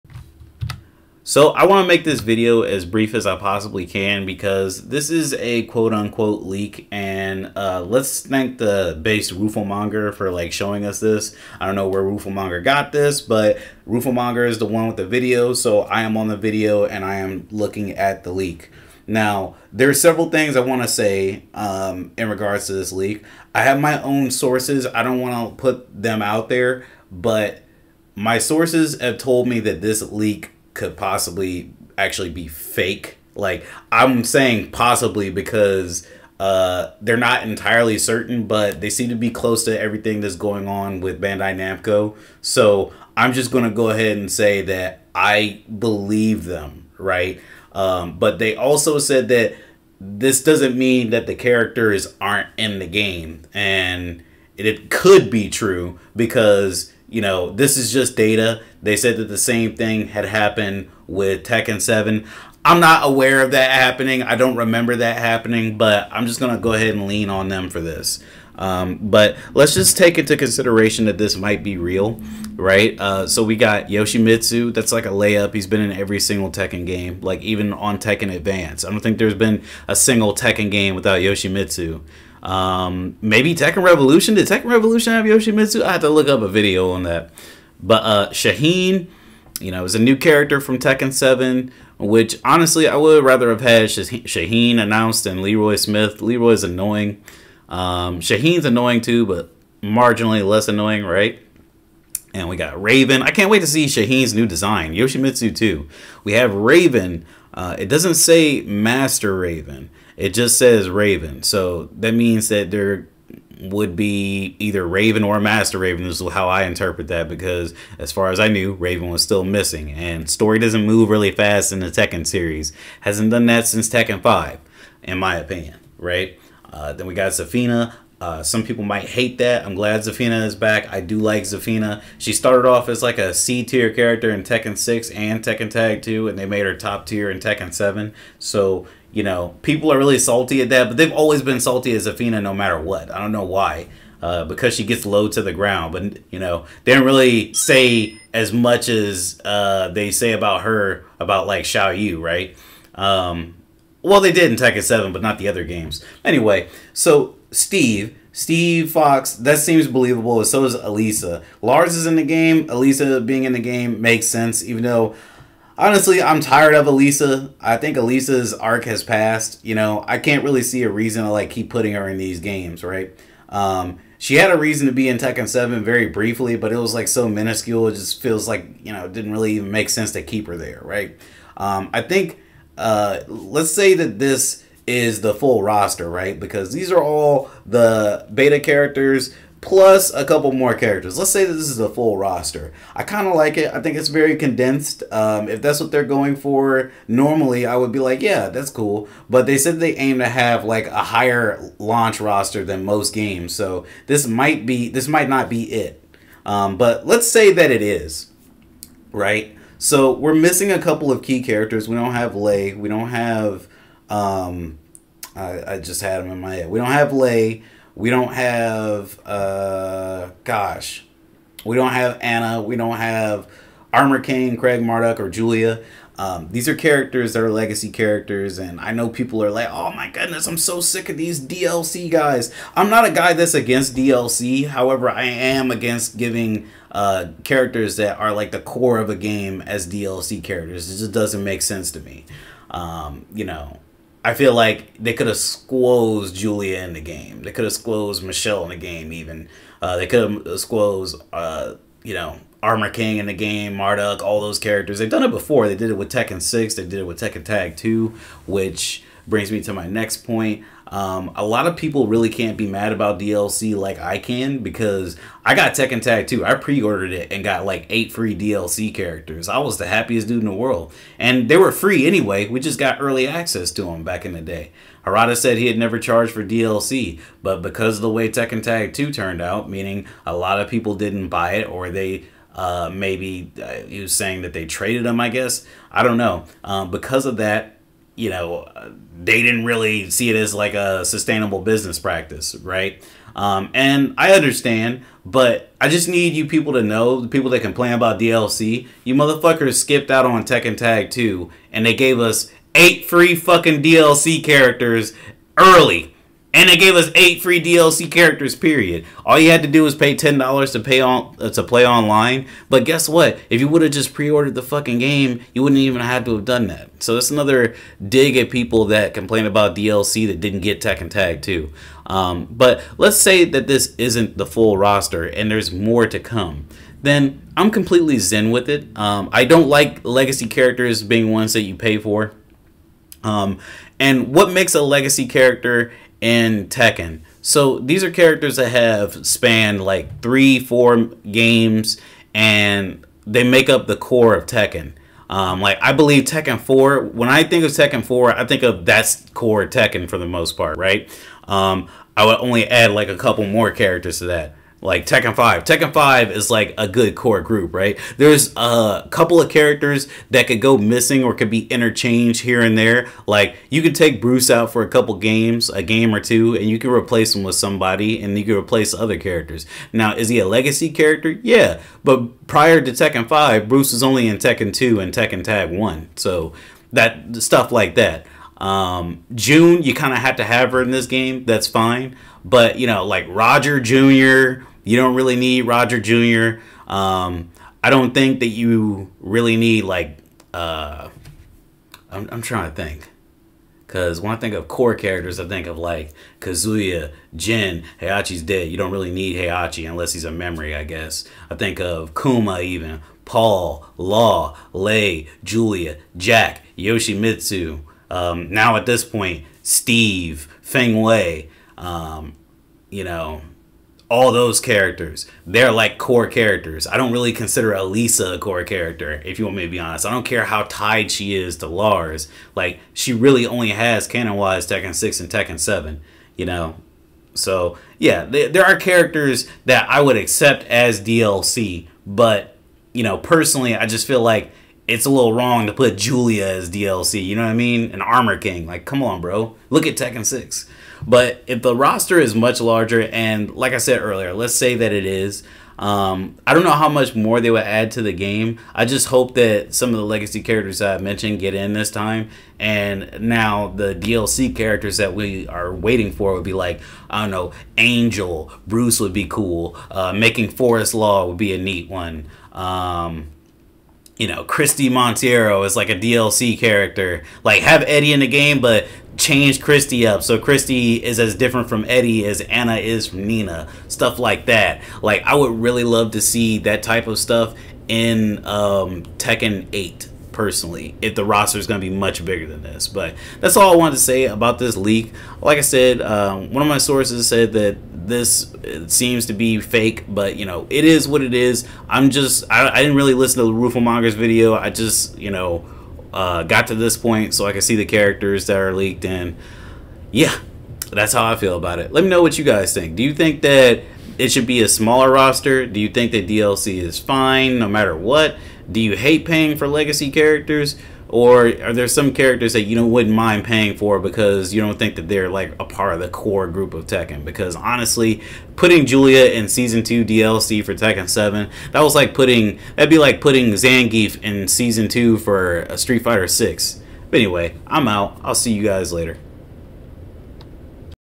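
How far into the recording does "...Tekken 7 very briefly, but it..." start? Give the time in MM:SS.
02:55.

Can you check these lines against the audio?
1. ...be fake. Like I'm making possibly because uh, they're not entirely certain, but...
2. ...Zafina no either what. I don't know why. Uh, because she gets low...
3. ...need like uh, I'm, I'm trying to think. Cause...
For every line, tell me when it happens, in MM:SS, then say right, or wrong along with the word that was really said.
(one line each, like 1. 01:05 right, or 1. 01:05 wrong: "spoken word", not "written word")
1. 00:32 wrong: "saying", not "making"
2. 02:22 wrong: "matter", not "either"
3. 06:29 right.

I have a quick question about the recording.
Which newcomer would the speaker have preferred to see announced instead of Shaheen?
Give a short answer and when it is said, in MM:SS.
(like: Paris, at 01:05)
Leroy Smith, at 01:35.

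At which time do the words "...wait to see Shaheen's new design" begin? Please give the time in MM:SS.
01:43.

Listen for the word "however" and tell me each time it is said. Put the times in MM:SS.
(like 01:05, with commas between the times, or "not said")
03:54.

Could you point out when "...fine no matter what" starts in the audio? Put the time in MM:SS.
08:26.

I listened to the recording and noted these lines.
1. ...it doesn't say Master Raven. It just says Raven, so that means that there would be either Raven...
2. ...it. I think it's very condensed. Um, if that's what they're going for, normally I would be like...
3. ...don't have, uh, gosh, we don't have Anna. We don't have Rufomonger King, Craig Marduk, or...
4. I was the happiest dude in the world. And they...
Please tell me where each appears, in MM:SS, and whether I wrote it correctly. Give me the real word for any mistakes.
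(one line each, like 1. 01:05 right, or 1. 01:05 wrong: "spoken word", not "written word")
1. 01:47 right
2. 03:13 right
3. 03:38 wrong: "Armor", not "Rufomonger"
4. 04:29 right.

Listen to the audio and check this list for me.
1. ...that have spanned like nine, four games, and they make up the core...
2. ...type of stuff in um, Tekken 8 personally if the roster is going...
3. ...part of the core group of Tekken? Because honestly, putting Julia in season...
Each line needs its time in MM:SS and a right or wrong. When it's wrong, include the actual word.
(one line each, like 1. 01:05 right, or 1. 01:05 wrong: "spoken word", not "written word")
1. 05:38 wrong: "three", not "nine"
2. 07:56 right
3. 08:35 right.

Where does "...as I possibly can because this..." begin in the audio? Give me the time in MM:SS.
00:03.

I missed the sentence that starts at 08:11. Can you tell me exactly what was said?
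I'm just, I, I didn't really listen to the Rufo Mongers video.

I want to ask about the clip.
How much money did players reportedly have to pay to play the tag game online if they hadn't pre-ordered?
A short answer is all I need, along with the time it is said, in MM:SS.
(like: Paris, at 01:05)
$10, at 05:10.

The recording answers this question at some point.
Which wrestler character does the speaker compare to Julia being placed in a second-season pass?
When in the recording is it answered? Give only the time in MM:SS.
08:43.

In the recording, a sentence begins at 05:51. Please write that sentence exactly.
Um, I would only add like a couple more characters to that like Tekken 5.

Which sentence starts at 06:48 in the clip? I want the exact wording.
Um, now at this point, Steve, Feng Wei.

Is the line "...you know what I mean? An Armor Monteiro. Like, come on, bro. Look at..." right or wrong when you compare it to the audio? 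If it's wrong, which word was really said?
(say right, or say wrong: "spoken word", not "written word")
wrong: "King", not "Monteiro".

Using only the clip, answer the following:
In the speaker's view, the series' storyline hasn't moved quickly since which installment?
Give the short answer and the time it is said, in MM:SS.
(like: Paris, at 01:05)
Tekken 5, at 02:03.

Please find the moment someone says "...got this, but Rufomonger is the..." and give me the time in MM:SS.
00:12.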